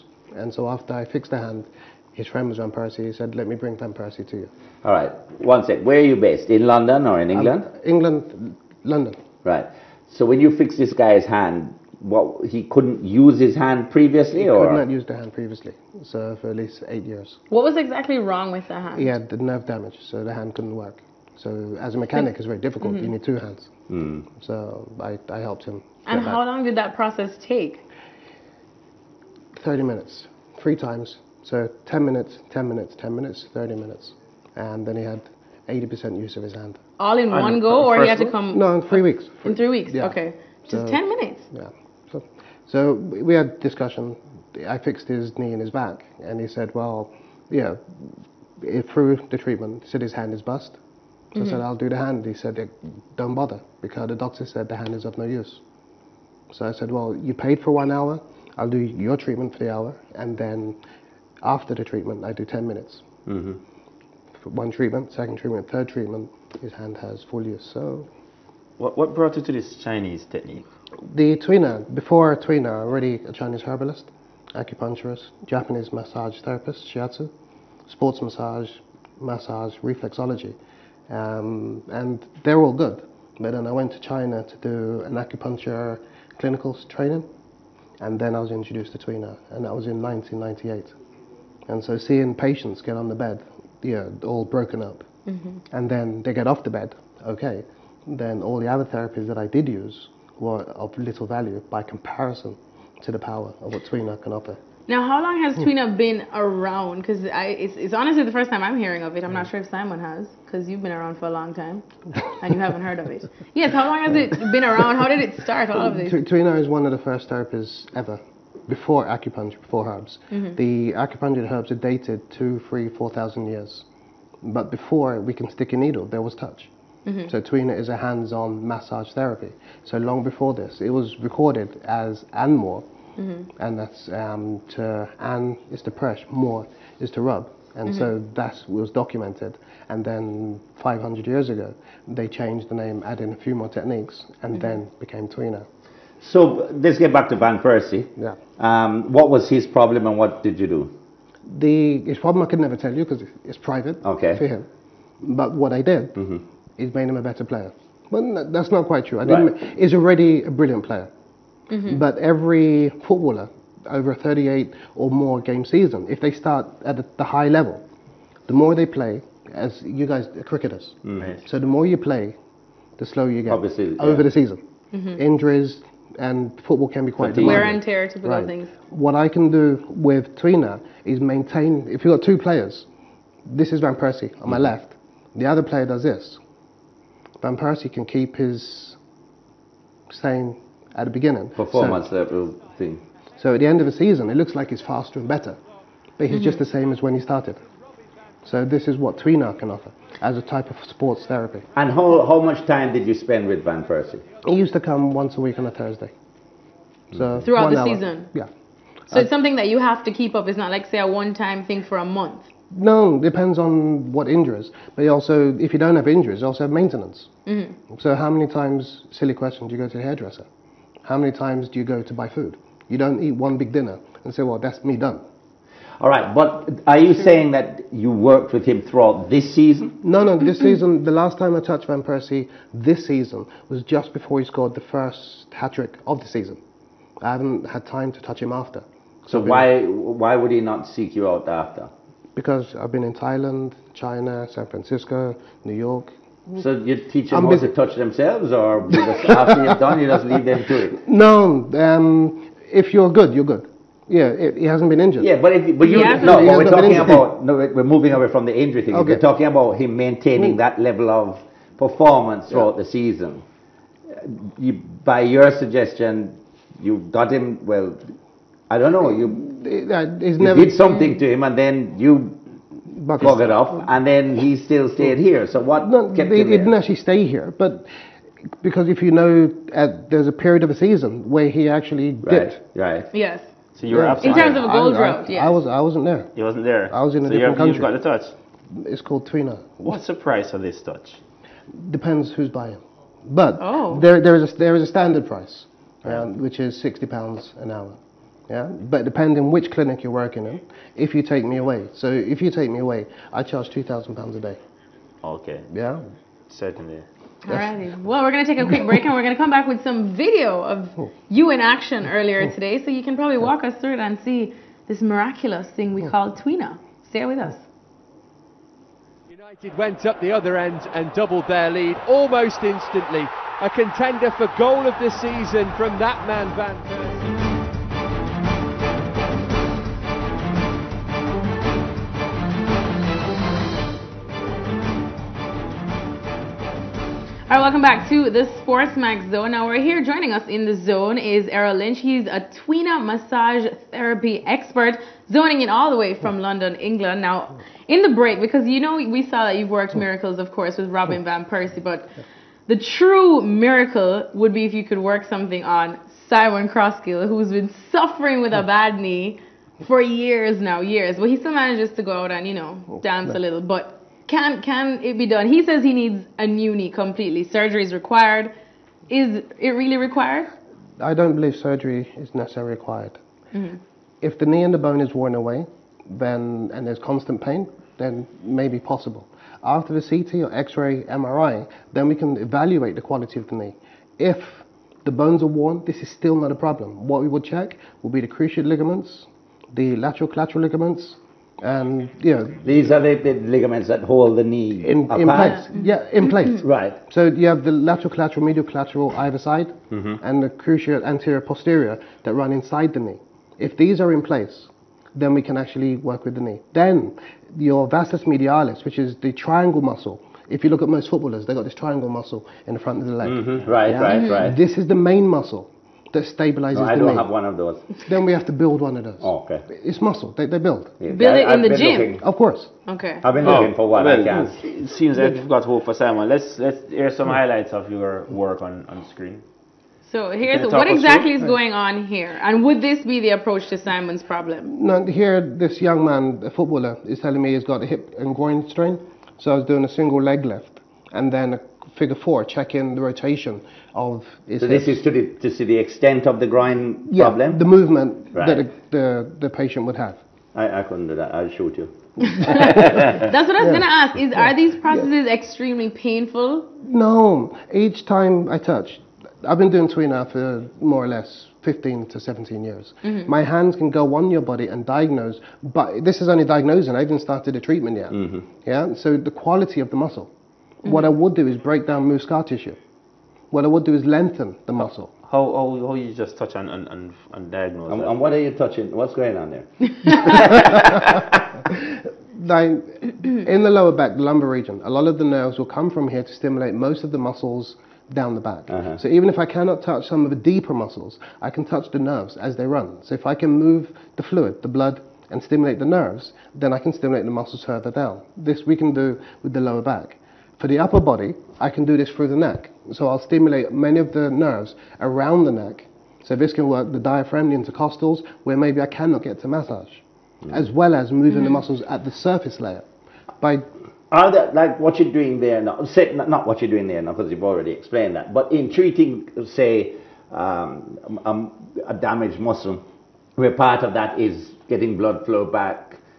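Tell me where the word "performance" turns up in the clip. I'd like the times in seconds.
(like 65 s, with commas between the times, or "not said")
191 s, 261 s.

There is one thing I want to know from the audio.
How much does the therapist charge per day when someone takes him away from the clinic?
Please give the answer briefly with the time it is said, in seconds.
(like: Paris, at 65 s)
£2,000, at 303 s.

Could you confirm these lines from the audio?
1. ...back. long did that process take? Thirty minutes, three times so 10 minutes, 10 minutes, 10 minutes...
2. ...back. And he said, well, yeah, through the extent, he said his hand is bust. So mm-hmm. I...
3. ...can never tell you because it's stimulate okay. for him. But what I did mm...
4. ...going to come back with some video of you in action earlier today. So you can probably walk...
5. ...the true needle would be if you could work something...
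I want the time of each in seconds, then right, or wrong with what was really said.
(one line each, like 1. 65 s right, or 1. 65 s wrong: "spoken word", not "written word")
1. 26 s right
2. 45 s wrong: "treatment", not "extent"
3. 152 s wrong: "private", not "stimulate"
4. 309 s right
5. 352 s wrong: "miracle", not "needle".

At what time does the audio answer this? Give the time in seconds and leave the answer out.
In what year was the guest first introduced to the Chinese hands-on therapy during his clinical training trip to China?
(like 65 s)
90 s.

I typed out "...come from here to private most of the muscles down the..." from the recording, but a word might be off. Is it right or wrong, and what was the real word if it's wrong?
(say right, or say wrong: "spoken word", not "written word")
wrong: "stimulate", not "private".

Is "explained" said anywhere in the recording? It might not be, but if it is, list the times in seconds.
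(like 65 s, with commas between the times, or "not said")
517 s.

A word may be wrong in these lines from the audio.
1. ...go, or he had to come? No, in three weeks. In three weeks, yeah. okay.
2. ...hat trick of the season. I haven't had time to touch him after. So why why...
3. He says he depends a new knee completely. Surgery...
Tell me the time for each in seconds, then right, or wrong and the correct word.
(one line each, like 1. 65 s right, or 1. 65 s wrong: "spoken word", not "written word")
1. 37 s right
2. 235 s right
3. 365 s wrong: "needs", not "depends".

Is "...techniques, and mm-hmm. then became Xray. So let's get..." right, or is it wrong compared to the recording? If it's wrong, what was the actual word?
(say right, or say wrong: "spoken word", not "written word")
wrong: "Tuina", not "Xray".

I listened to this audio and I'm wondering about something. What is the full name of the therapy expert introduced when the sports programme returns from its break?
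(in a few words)
Errol Lynch.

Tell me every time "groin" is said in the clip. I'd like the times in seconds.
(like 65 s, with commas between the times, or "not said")
438 s, 446 s.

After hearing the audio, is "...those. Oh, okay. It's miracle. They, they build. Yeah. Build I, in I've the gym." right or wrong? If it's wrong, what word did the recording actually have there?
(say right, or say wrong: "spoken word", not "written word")
wrong: "muscle", not "miracle".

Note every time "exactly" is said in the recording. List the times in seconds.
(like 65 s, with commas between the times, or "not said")
17 s, 430 s.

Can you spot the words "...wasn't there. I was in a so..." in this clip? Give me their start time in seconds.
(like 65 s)
286 s.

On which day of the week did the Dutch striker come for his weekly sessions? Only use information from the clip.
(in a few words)
Thursday.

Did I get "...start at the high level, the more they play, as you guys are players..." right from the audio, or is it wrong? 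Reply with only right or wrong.
wrong.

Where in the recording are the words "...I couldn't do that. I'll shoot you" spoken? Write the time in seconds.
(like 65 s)
450 s.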